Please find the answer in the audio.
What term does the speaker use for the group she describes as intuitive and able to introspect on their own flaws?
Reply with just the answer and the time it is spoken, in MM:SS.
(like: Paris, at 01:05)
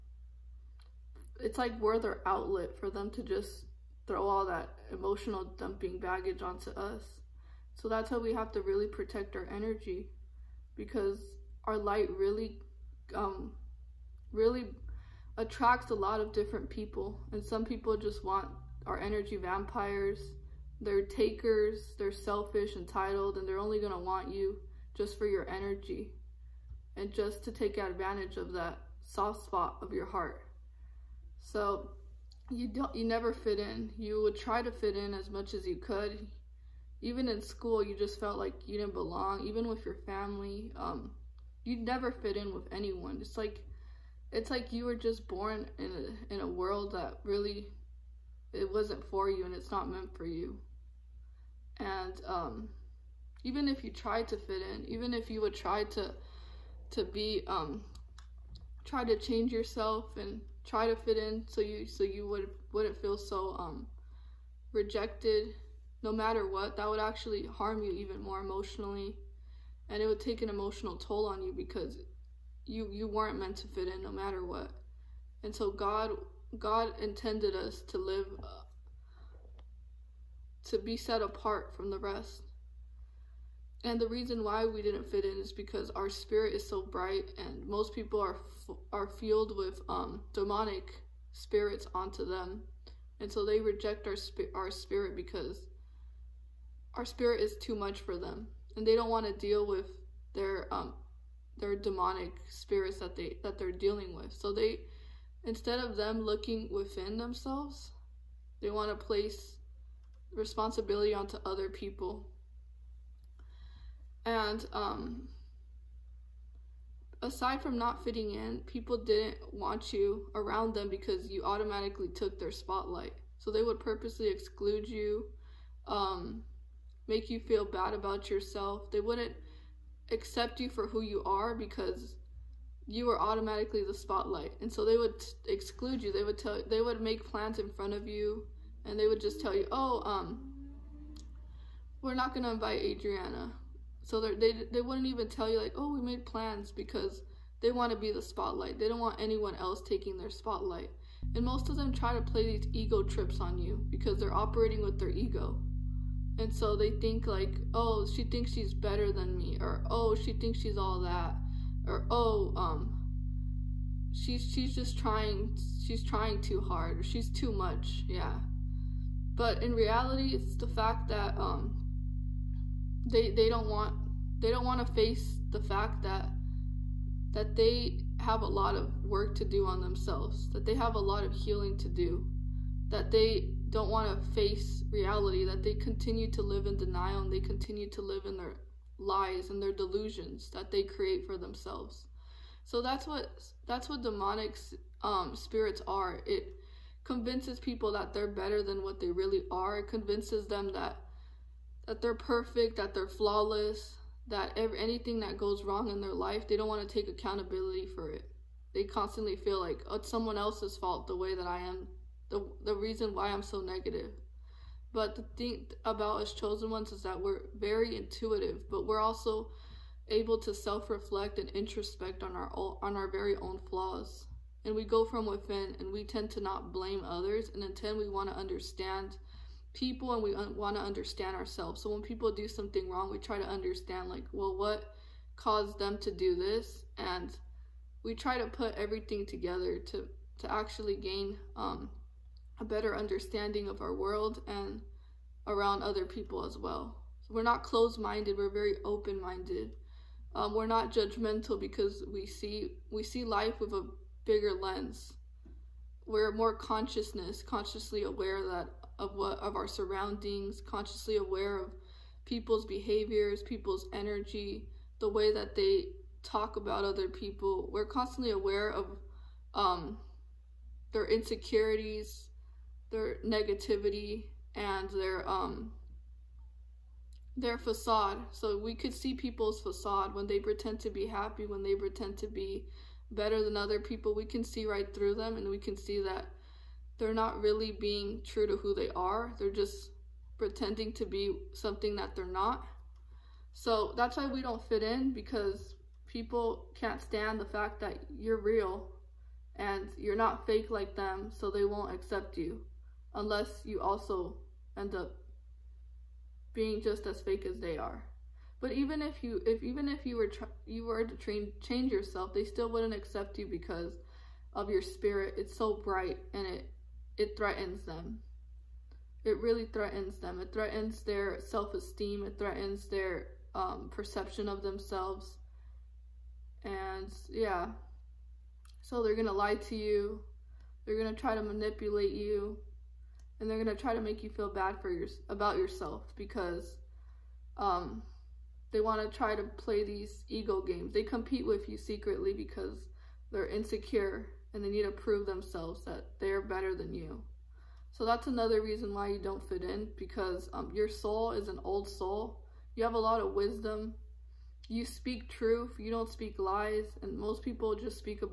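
chosen ones, at 03:36.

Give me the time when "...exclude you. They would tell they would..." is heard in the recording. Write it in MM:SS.
02:15.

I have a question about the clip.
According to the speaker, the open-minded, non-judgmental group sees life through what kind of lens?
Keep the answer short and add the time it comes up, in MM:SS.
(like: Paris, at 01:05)
bigger lens, at 04:14.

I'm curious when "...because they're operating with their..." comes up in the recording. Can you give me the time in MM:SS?
02:33.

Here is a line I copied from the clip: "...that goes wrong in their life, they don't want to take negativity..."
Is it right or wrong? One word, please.
wrong.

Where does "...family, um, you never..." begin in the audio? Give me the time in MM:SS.
00:40.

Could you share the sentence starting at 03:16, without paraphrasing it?
It convinces people that they're better than what they really are.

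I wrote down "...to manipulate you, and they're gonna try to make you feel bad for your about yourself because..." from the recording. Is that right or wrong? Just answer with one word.
right.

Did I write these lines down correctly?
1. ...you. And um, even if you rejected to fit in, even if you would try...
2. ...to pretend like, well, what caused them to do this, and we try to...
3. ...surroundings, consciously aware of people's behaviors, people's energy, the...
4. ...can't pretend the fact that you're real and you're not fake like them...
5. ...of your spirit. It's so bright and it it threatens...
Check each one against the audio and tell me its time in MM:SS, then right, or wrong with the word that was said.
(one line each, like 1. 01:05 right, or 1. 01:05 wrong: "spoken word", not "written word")
1. 00:50 wrong: "tried", not "rejected"
2. 03:53 wrong: "understand", not "pretend"
3. 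04:19 right
4. 04:56 wrong: "stand", not "pretend"
5. 05:14 right.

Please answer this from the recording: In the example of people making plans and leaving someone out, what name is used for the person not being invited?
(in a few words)
Adriana.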